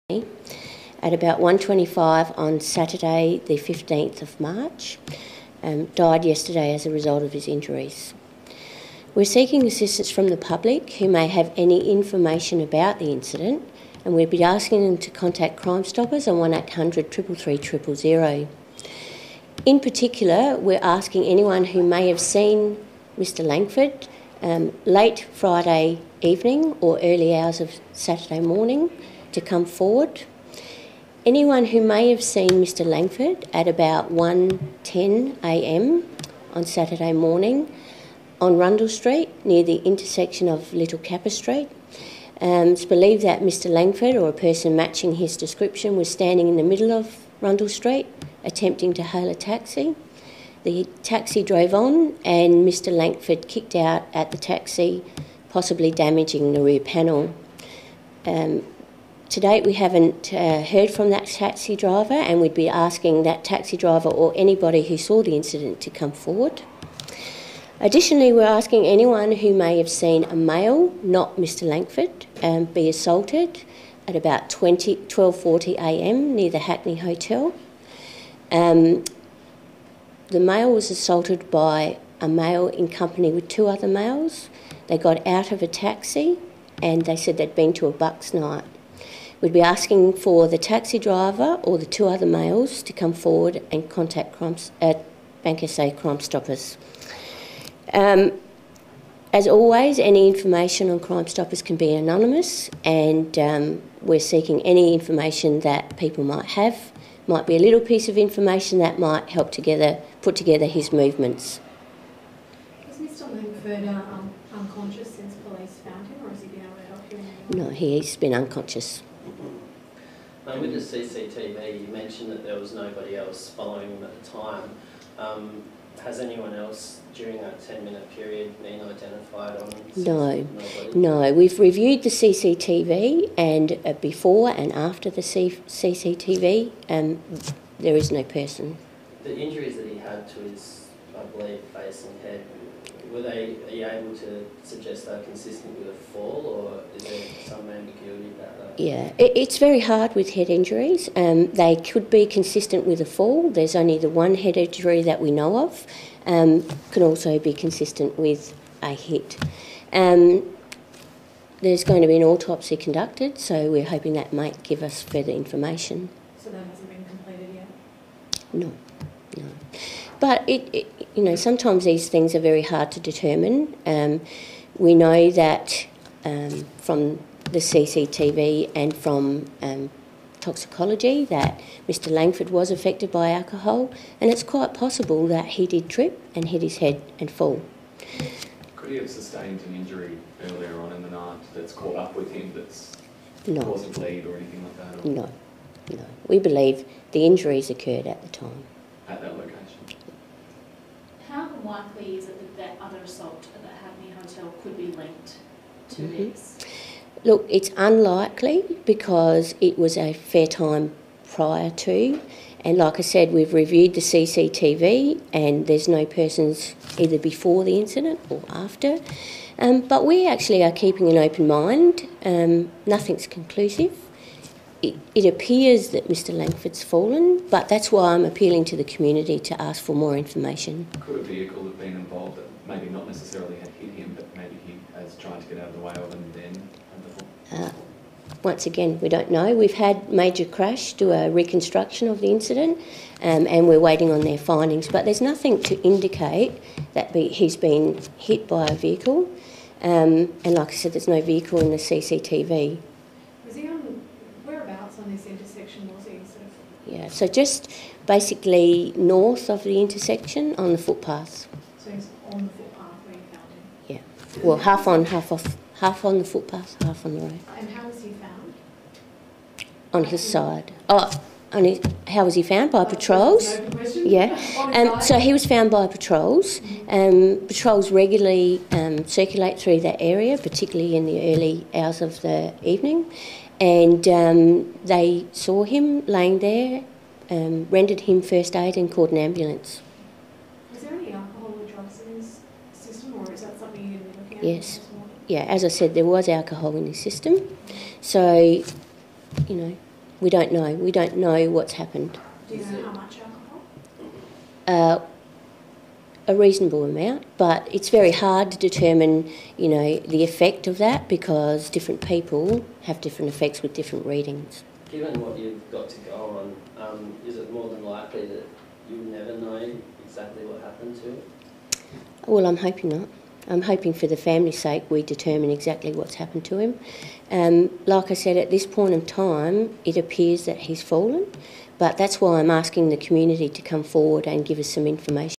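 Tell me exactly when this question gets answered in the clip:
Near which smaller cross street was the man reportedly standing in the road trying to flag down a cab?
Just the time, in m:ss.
0:40.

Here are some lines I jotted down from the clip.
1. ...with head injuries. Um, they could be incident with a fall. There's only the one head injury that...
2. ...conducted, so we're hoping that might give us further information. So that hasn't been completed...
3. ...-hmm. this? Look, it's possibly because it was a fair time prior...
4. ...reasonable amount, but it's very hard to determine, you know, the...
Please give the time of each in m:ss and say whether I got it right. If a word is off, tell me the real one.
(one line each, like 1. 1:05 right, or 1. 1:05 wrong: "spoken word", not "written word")
1. 2:30 wrong: "consistent", not "incident"
2. 2:42 right
3. 3:26 wrong: "unlikely", not "possibly"
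4. 5:06 right.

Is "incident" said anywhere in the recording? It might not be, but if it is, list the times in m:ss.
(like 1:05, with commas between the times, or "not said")
0:13, 1:05, 3:37, 4:02.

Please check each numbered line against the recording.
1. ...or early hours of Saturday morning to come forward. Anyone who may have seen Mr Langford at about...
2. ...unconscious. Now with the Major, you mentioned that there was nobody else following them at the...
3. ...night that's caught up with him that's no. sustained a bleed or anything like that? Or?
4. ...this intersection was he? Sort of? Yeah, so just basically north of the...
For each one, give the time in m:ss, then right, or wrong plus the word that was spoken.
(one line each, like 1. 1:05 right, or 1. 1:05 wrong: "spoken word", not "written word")
1. 0:26 right
2. 1:58 wrong: "CCTV", not "Major"
3. 3:11 wrong: "caused", not "sustained"
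4. 4:15 right.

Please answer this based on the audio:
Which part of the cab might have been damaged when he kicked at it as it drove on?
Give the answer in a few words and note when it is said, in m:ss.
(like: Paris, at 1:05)
rear panel, at 0:56.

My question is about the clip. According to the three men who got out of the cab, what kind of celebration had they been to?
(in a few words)
bucks night.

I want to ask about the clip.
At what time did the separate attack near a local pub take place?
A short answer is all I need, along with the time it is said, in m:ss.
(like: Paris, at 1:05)
12:40am, at 1:14.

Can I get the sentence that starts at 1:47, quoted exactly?
Might be a little piece of information that might help together put together his movements.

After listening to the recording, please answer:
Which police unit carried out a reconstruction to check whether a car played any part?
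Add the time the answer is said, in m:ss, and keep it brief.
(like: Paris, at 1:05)
Major Crash, at 4:00.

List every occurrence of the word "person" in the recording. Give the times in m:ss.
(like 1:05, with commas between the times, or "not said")
0:44, 2:18, 3:36.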